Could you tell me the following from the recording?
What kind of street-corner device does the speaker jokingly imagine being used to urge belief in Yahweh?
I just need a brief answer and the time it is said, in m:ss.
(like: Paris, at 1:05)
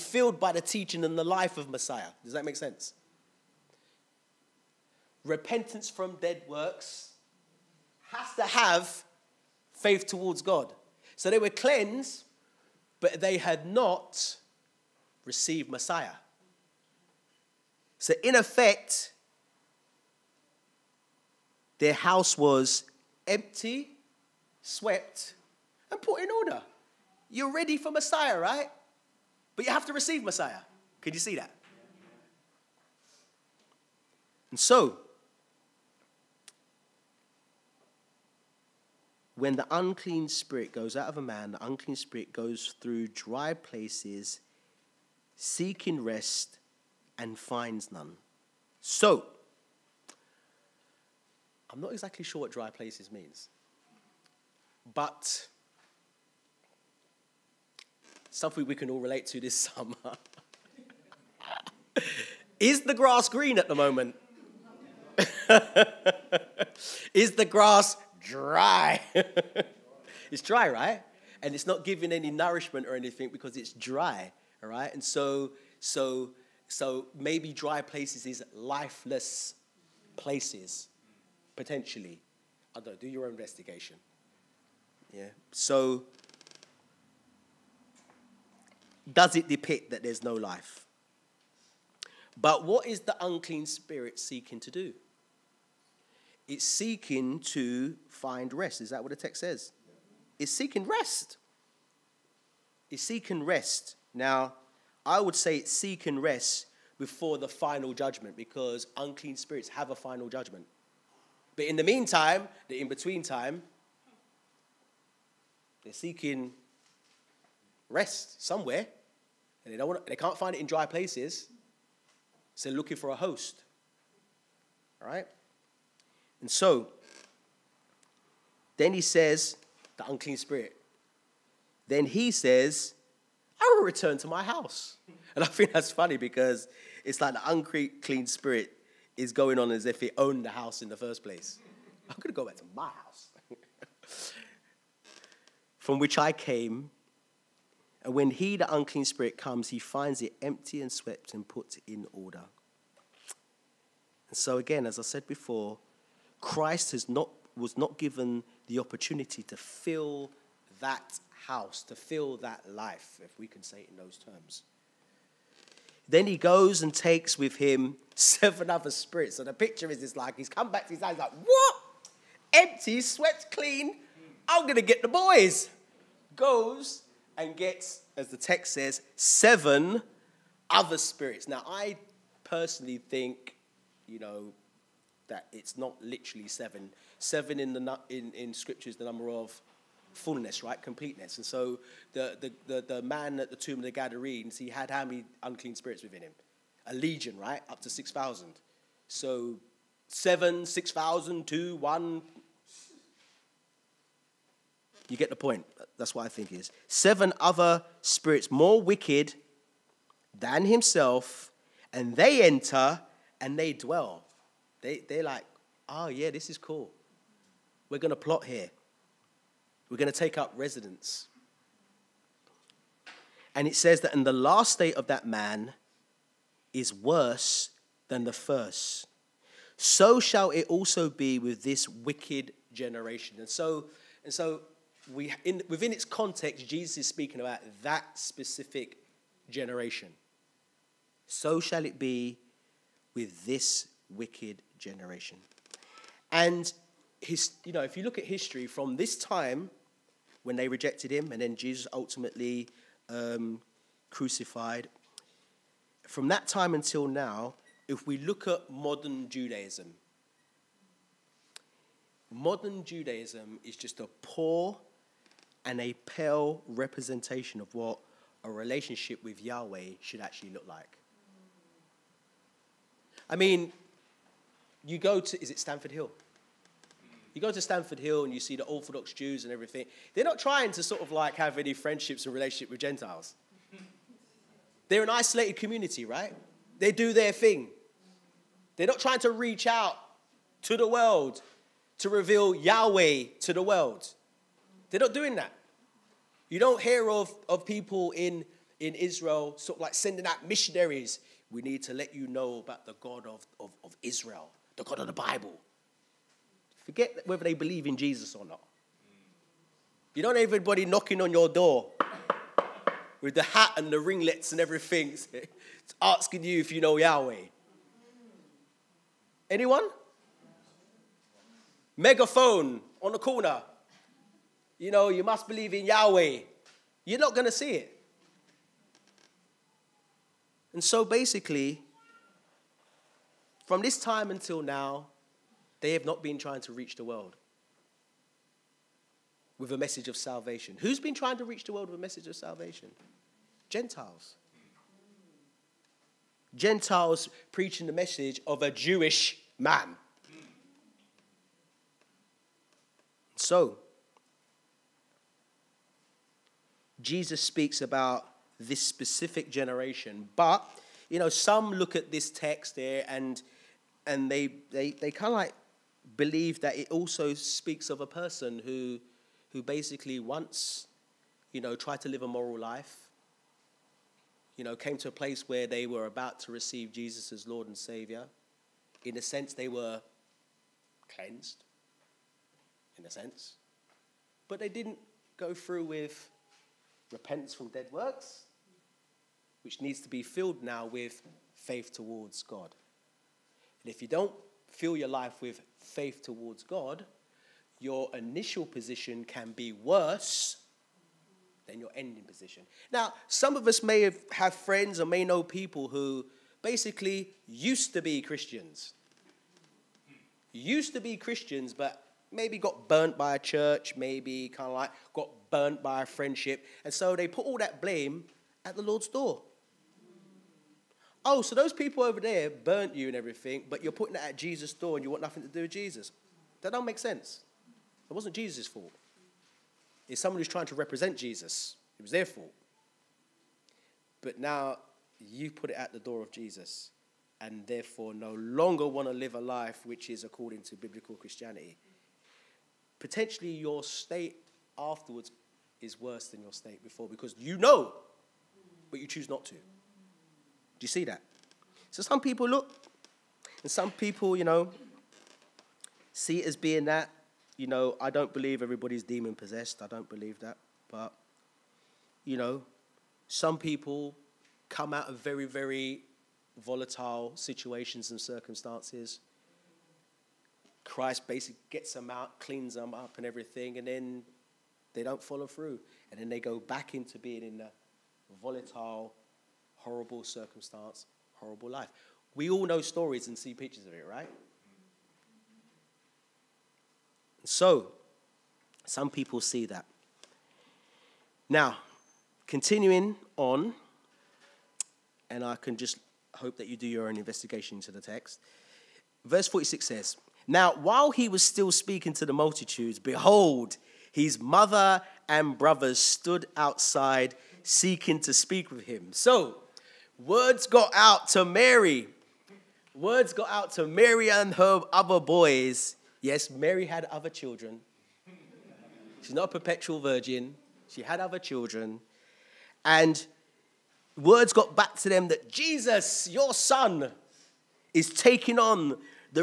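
Megaphone, at 5:21.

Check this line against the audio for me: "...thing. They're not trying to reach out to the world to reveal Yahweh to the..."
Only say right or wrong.
right.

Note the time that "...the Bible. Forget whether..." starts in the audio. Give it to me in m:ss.
5:05.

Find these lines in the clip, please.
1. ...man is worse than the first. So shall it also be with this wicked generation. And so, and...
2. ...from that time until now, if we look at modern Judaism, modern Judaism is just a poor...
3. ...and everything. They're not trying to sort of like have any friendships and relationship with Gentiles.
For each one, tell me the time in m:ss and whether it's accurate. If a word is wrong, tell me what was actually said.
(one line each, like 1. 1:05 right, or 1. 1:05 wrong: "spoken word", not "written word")
1. 3:45 right
2. 4:16 right
3. 4:39 right.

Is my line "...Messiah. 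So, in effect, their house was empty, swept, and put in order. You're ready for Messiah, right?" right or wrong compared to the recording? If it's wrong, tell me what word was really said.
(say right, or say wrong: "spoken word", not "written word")
right.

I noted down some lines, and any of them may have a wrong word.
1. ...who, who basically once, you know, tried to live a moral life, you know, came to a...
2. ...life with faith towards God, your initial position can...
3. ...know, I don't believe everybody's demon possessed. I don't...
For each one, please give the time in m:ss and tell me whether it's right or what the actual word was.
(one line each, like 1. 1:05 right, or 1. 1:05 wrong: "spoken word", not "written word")
1. 6:08 right
2. 6:35 right
3. 7:37 right.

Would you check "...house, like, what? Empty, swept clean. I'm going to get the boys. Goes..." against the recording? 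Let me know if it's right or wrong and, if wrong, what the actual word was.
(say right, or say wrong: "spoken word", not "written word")
right.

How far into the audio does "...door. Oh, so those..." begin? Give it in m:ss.
6:59.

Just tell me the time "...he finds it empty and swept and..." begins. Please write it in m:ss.
2:29.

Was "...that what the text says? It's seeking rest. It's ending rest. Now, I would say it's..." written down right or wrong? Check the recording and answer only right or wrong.
wrong.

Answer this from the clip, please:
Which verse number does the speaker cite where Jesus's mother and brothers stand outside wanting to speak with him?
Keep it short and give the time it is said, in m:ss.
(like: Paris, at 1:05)
Verse 46, at 8:19.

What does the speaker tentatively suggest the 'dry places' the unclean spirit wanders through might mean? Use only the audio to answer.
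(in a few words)
Lifeless places.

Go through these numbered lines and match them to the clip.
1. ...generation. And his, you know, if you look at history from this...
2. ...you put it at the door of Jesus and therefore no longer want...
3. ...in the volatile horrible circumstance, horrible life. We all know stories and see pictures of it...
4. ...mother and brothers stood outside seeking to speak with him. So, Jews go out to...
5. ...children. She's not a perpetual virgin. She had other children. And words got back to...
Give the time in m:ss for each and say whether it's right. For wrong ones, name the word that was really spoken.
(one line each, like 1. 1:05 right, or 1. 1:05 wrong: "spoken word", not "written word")
1. 4:04 right
2. 7:15 right
3. 7:57 right
4. 8:24 wrong: "Words", not "Jews"
5. 8:37 right.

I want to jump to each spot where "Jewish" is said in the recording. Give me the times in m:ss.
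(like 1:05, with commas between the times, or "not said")
5:48.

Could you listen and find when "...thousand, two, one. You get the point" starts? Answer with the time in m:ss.
3:20.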